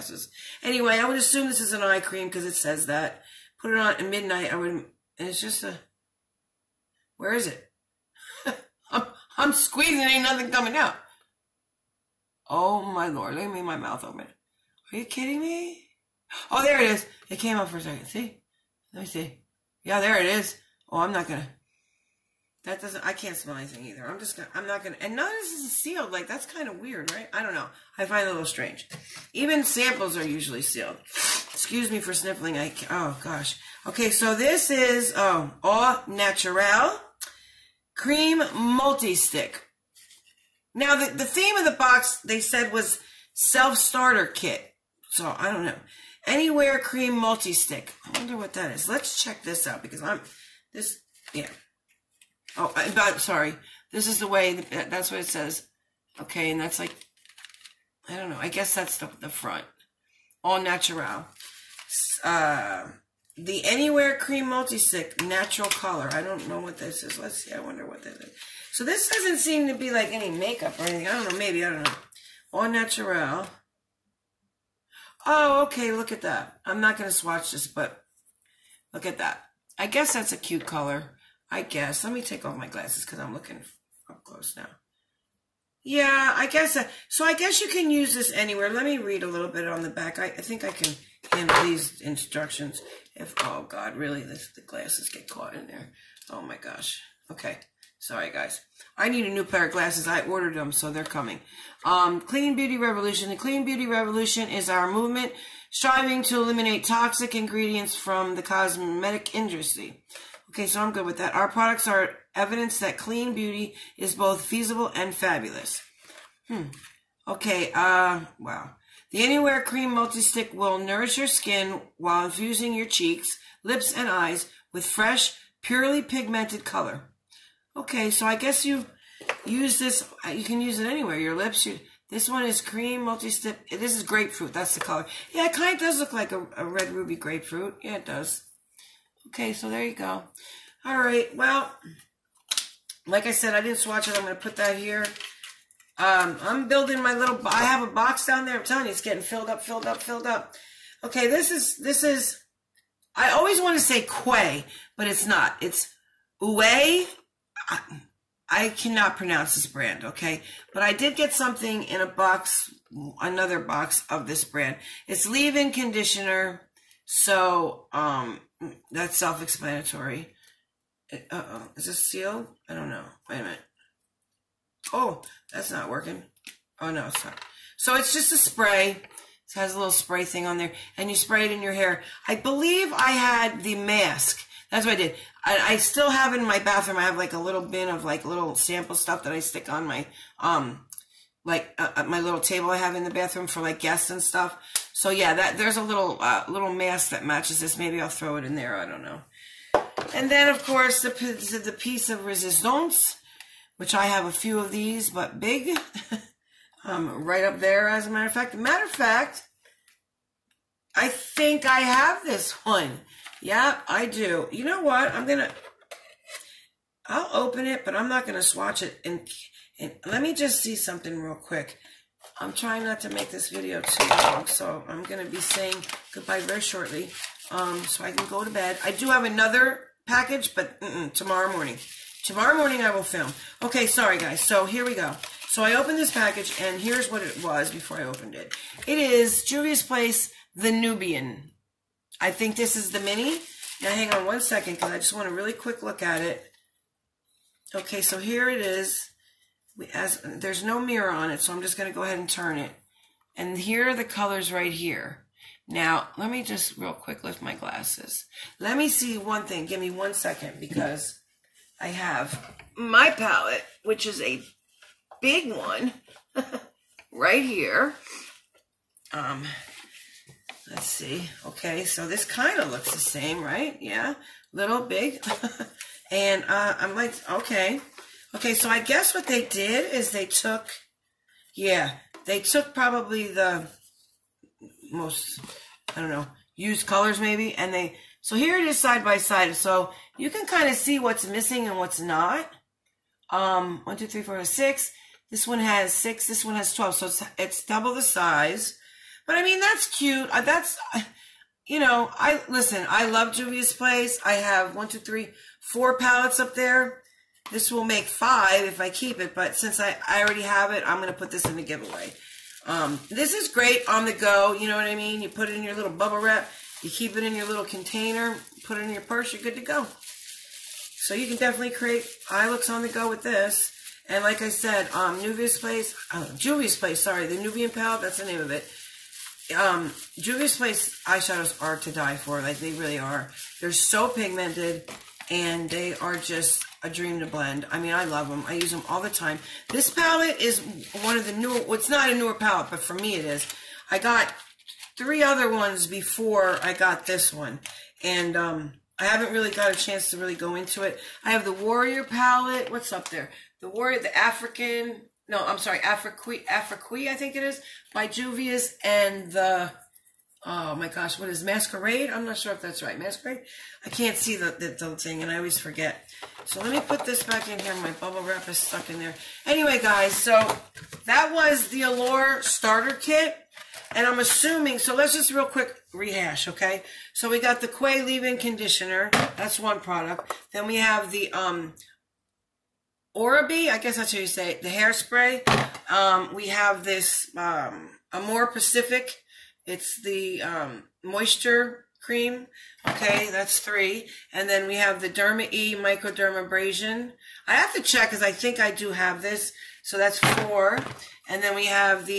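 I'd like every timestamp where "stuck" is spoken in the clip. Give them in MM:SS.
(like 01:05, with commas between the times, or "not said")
06:08.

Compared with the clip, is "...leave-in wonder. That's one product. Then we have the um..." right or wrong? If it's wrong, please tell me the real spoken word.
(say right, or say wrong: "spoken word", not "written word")
wrong: "conditioner", not "wonder".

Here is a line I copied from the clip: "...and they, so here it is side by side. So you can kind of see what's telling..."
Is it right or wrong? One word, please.
wrong.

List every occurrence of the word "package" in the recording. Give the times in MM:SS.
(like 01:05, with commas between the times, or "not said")
03:50, 03:56.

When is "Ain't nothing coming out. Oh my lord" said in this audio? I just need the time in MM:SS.
00:09.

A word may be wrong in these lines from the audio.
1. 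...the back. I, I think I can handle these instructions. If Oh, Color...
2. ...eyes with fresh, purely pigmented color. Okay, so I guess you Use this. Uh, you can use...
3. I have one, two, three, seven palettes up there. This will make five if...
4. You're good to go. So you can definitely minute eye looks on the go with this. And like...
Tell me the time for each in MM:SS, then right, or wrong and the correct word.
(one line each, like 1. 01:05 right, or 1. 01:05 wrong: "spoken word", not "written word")
1. 01:29 wrong: "God", not "Color"
2. 02:04 right
3. 05:04 wrong: "four", not "seven"
4. 05:19 wrong: "create", not "minute".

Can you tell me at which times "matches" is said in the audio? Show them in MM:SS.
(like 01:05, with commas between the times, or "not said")
03:17.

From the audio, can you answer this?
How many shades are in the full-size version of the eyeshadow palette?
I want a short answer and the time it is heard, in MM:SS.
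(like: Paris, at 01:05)
12, at 04:56.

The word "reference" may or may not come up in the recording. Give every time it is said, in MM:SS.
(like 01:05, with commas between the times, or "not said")
not said.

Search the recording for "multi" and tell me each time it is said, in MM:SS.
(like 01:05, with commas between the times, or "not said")
00:38, 00:47, 01:04, 01:59, 02:13.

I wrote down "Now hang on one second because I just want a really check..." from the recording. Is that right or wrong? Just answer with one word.
wrong.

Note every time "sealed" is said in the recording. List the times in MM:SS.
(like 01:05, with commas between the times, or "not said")
00:25, 00:30, 02:51.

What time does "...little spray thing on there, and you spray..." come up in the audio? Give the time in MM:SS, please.
02:59.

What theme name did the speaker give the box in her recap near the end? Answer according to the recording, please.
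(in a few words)
Allure starter kit.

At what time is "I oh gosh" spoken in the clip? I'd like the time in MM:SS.
00:32.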